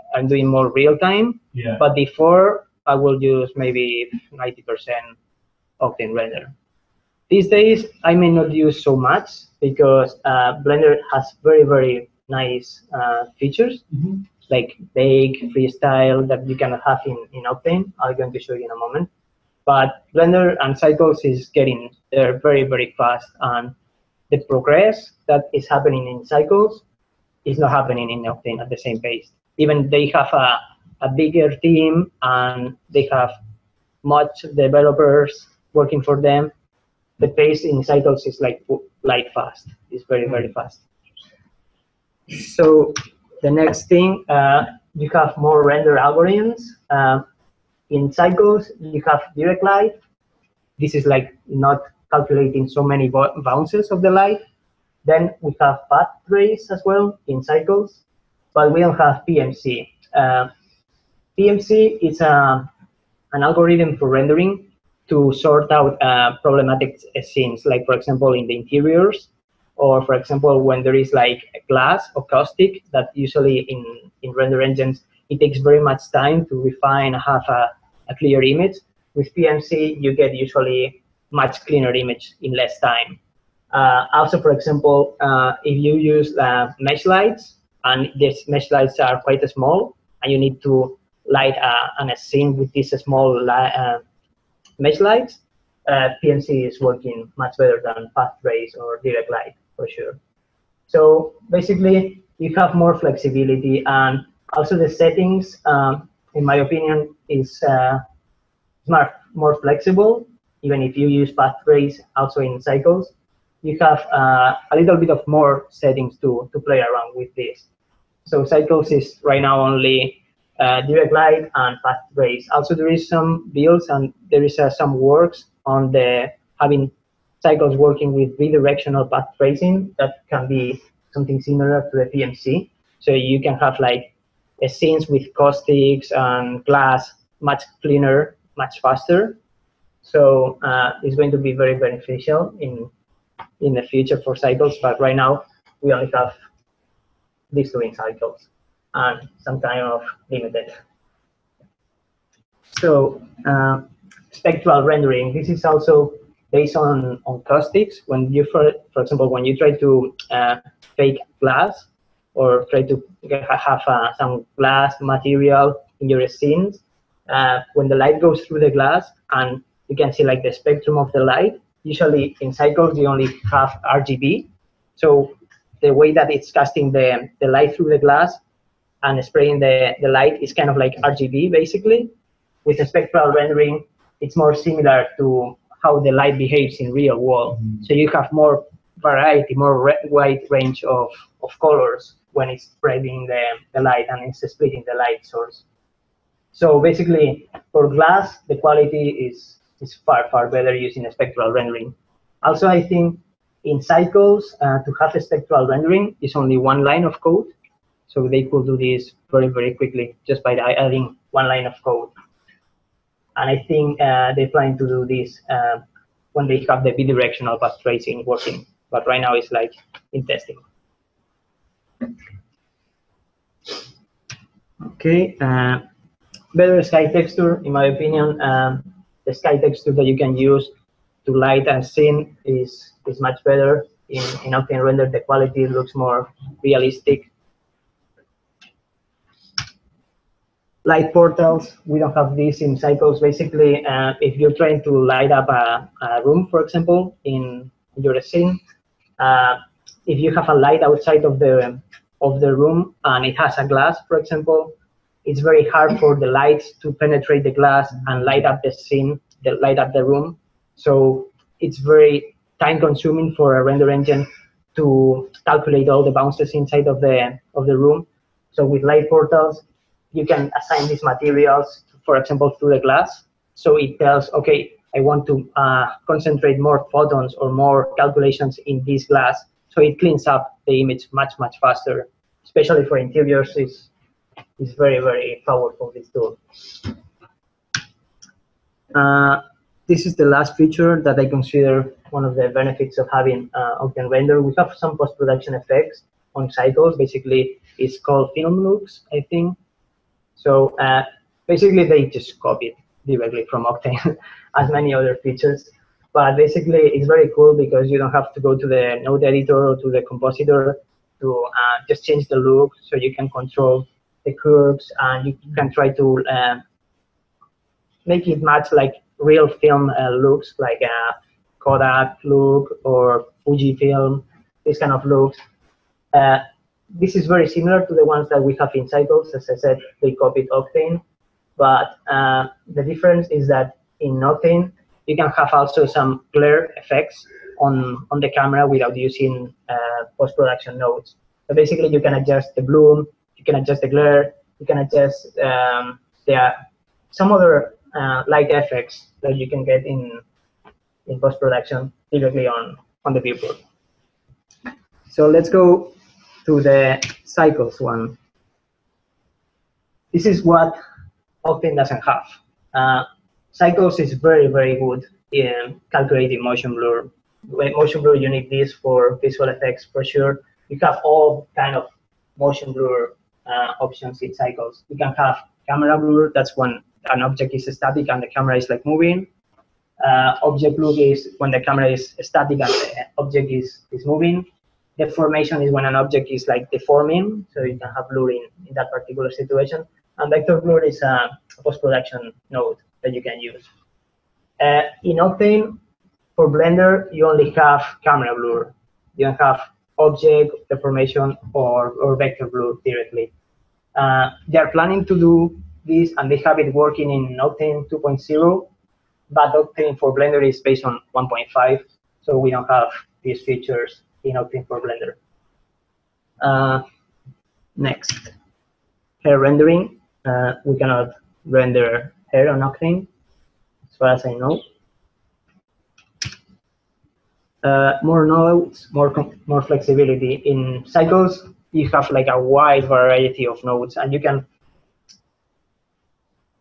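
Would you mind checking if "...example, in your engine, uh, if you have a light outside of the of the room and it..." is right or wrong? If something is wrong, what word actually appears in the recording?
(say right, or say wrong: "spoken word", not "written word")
wrong: "scene", not "engine".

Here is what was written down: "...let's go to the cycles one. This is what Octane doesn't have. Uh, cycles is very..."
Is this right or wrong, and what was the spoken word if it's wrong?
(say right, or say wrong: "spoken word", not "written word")
right.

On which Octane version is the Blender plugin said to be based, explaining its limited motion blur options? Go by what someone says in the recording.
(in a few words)
1.5.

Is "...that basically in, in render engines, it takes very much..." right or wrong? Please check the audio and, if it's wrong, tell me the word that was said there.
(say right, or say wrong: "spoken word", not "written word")
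wrong: "usually", not "basically".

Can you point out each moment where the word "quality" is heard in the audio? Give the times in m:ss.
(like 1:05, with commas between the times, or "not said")
3:18, 3:55.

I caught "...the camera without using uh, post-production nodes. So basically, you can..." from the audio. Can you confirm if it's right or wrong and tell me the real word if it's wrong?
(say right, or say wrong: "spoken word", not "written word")
right.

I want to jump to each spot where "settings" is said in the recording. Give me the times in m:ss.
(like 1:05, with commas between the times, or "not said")
1:44, 1:55.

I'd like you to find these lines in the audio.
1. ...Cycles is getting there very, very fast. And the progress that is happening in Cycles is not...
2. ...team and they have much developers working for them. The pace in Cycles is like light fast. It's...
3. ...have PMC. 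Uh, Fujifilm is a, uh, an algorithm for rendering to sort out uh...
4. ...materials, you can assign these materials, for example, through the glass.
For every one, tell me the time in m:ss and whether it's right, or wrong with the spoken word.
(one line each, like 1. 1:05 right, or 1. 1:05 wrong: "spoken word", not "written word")
1. 0:20 right
2. 0:31 right
3. 0:58 wrong: "PMC", not "Fujifilm"
4. 4:29 wrong: "portals", not "materials".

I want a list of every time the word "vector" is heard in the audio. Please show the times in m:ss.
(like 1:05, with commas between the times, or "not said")
6:30, 6:42.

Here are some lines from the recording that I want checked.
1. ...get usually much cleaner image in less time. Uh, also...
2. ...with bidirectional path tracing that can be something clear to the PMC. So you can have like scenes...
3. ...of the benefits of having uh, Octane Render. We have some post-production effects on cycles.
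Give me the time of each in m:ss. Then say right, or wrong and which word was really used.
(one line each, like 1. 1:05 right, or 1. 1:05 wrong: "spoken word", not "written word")
1. 1:20 right
2. 2:08 wrong: "similar", not "clear"
3. 4:52 right.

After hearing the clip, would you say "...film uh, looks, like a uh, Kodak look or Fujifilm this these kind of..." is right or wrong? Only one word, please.
right.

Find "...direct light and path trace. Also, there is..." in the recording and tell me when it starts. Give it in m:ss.
2:00.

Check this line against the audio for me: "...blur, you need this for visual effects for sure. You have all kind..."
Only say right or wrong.
right.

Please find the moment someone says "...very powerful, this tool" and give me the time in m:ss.
4:44.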